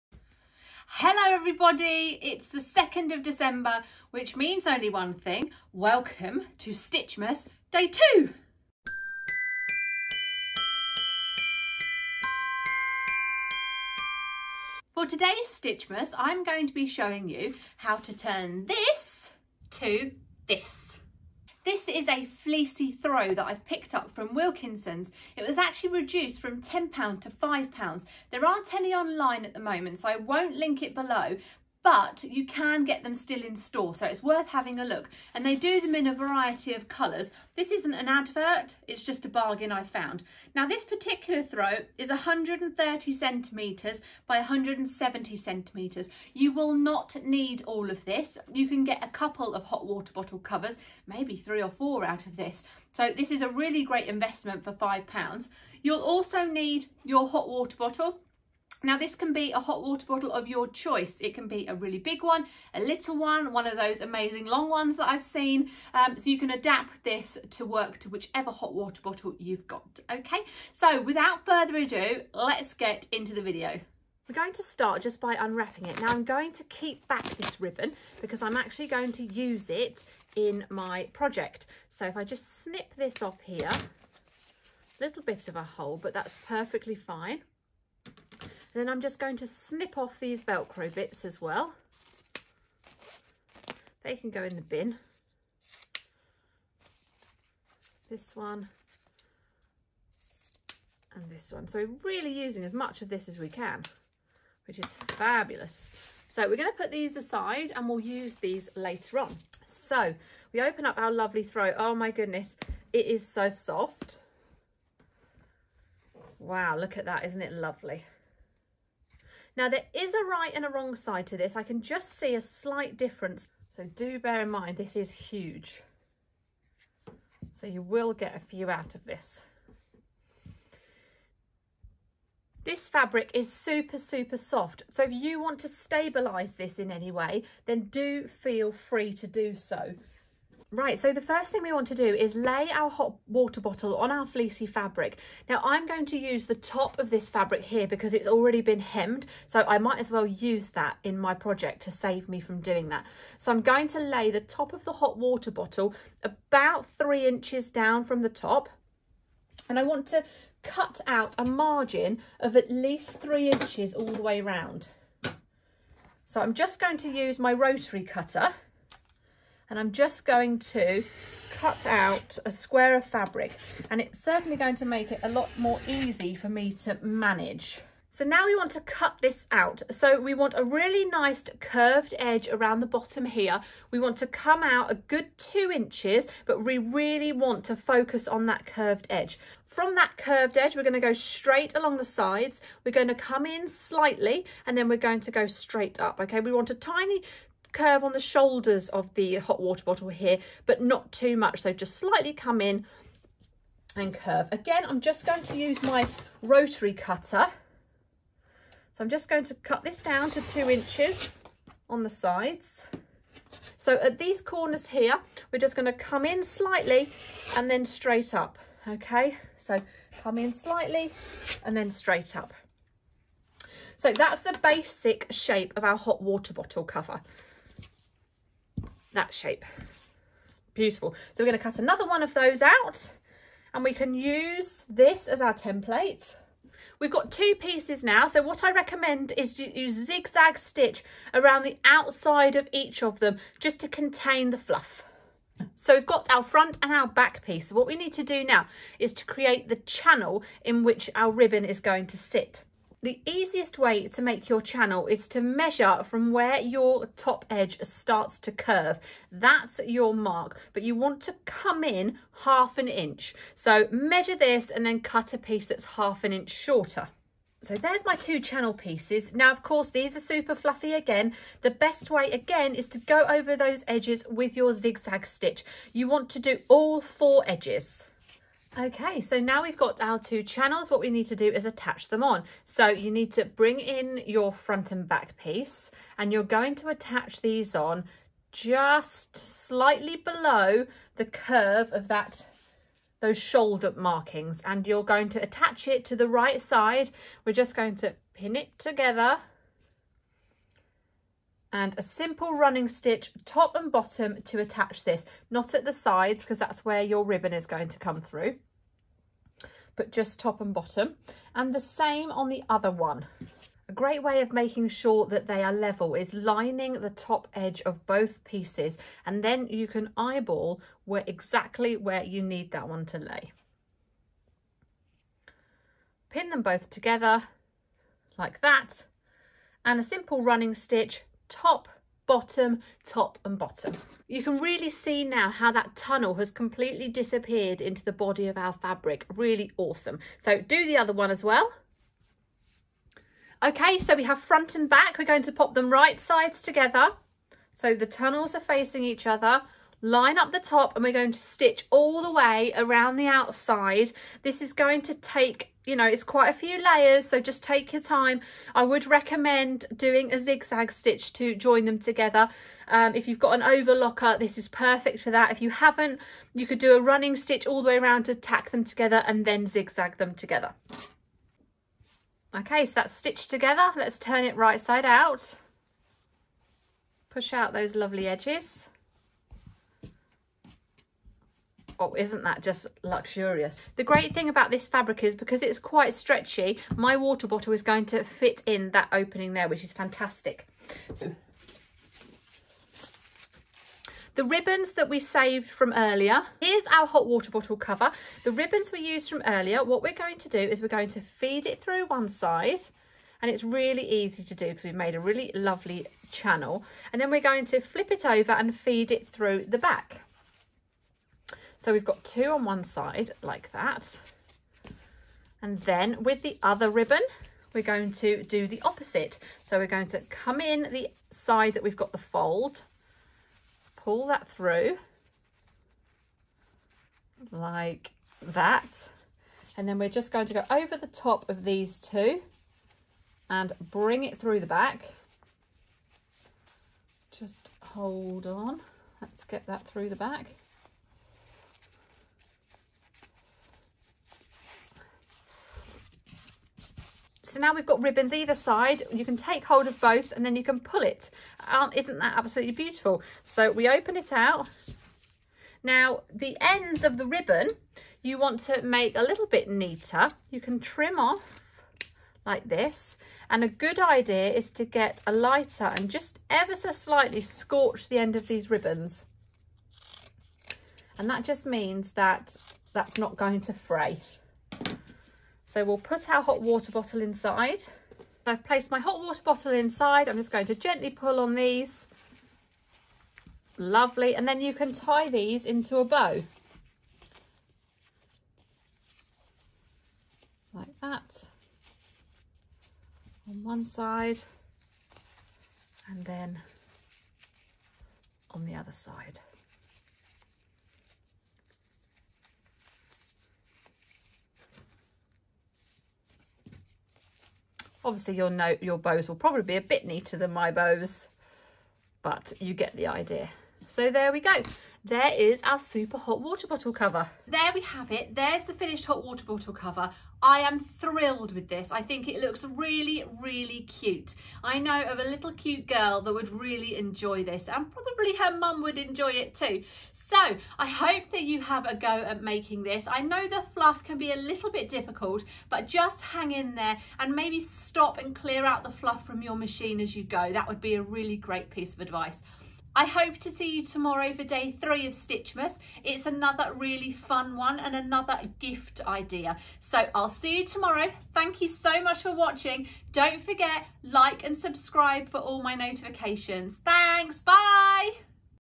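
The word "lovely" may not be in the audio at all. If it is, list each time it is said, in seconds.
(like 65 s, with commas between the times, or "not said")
111 s, 117 s, 377 s, 405 s, 483 s.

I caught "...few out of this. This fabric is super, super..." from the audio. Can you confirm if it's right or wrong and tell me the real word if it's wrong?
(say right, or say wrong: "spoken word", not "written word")
right.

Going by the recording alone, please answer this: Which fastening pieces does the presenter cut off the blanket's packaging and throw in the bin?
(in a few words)
Velcro.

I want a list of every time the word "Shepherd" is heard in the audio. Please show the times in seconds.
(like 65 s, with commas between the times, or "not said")
not said.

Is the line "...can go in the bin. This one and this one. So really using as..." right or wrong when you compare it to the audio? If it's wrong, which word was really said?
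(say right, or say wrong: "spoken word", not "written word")
right.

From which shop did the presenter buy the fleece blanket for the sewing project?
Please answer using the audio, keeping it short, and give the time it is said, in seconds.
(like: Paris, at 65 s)
Wilkinson's, at 24 s.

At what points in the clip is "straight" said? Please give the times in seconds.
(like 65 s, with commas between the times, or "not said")
191 s, 195 s, 217 s, 221 s.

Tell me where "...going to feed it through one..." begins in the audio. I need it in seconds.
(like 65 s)
400 s.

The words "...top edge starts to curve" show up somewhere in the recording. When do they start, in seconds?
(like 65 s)
257 s.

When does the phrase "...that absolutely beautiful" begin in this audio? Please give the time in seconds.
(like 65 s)
452 s.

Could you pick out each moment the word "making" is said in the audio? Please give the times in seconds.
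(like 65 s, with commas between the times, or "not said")
314 s, 532 s.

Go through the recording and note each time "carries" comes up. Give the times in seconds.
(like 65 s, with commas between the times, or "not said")
not said.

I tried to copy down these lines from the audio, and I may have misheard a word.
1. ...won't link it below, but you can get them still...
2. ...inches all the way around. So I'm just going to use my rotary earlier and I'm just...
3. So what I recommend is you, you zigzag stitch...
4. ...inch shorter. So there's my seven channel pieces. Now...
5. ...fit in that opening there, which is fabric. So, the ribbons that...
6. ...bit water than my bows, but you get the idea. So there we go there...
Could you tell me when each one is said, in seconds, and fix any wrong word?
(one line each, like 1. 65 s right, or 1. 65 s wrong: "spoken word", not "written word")
1. 30 s right
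2. 163 s wrong: "cutter", not "earlier"
3. 238 s right
4. 266 s wrong: "two", not "seven"
5. 388 s wrong: "fantastic", not "fabric"
6. 509 s wrong: "neater", not "water".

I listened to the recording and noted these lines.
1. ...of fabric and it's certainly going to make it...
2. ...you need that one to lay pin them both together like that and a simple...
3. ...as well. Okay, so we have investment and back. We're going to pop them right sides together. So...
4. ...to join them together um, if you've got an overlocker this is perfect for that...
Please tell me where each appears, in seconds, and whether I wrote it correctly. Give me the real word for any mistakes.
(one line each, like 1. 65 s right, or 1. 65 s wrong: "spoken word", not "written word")
1. 172 s right
2. 322 s right
3. 341 s wrong: "front", not "investment"
4. 361 s right.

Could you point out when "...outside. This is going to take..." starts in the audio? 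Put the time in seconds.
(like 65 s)
353 s.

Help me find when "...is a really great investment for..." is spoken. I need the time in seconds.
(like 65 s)
53 s.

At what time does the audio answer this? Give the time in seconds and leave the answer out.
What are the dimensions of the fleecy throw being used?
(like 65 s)
42 s.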